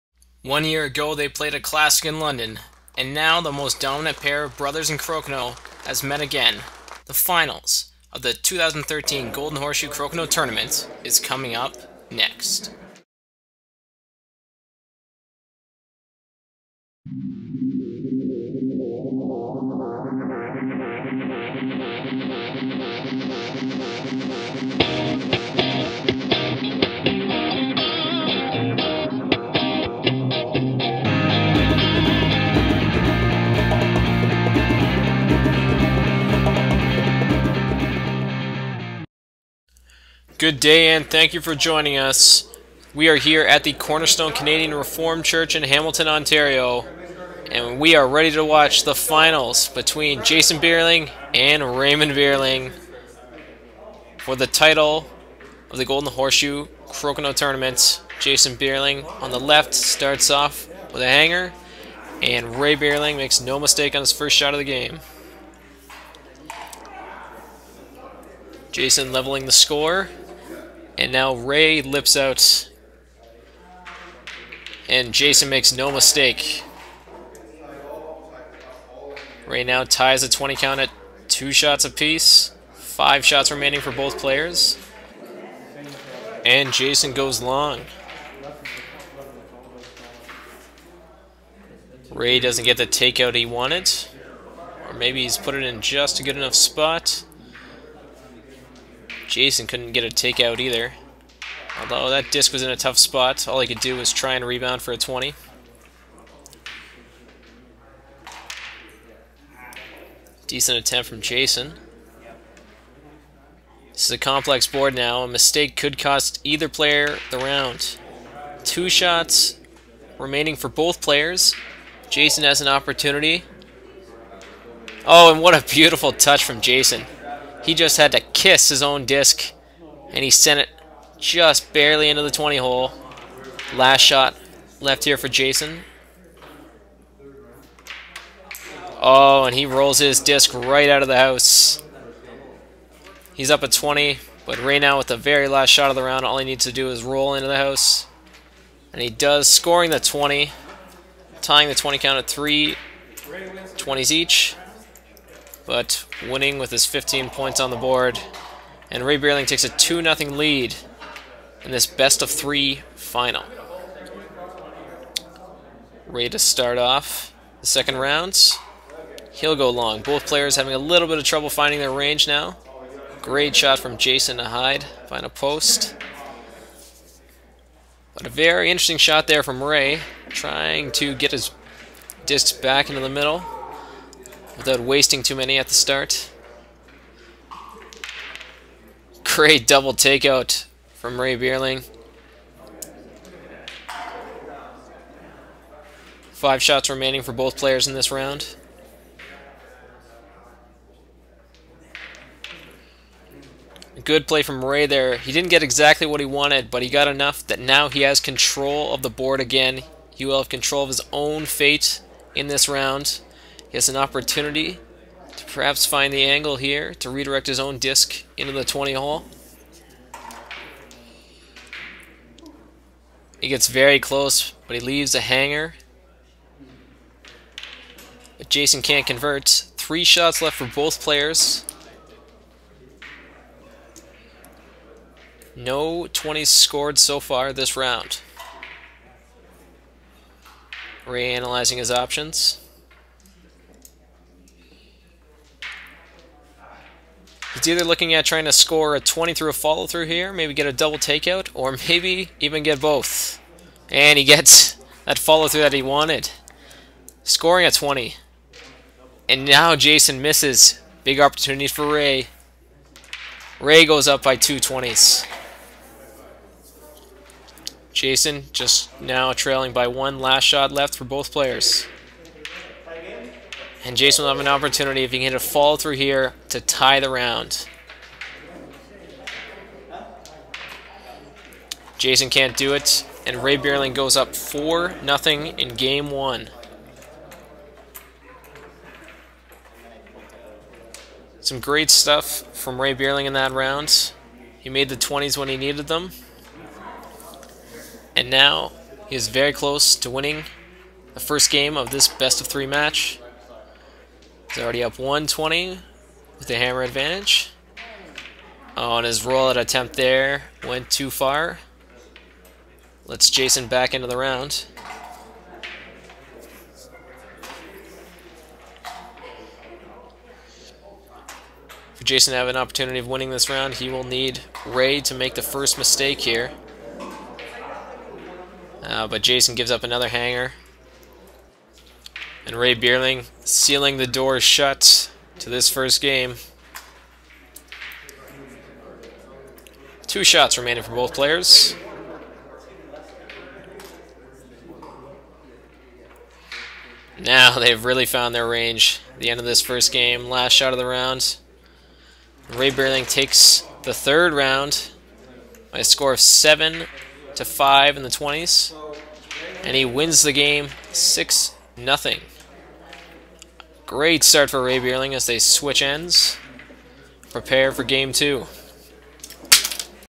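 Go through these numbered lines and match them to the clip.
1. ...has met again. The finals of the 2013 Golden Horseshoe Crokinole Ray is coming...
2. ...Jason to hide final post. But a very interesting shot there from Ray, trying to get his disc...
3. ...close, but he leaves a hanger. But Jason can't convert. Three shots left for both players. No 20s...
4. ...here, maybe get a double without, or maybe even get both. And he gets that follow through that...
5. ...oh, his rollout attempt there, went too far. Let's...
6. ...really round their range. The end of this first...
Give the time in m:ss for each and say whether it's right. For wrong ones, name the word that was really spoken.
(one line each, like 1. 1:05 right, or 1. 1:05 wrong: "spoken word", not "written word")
1. 0:05 wrong: "Tournament", not "Ray"
2. 2:53 right
3. 3:43 right
4. 4:10 wrong: "takeout", not "without"
5. 5:09 right
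6. 5:47 wrong: "found", not "round".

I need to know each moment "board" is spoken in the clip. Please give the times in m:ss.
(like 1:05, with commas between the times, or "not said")
1:54, 2:37, 3:29.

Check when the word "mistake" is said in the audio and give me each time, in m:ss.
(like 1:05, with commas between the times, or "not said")
1:03, 1:15, 1:55, 5:25.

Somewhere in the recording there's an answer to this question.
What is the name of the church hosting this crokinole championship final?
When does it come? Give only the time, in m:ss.
0:43.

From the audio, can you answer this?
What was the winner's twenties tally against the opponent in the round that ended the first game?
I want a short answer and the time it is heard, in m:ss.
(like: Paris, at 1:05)
7 to 5, at 5:56.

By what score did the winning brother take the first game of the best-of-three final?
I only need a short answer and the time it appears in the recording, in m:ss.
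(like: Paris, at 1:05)
6-0, at 6:00.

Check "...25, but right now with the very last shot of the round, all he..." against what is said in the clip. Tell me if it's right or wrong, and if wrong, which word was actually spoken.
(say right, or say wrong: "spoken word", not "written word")
wrong: "20", not "25".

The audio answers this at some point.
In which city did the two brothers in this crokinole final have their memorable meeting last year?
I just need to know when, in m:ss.
0:02.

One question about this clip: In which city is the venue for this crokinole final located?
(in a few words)
Hamilton.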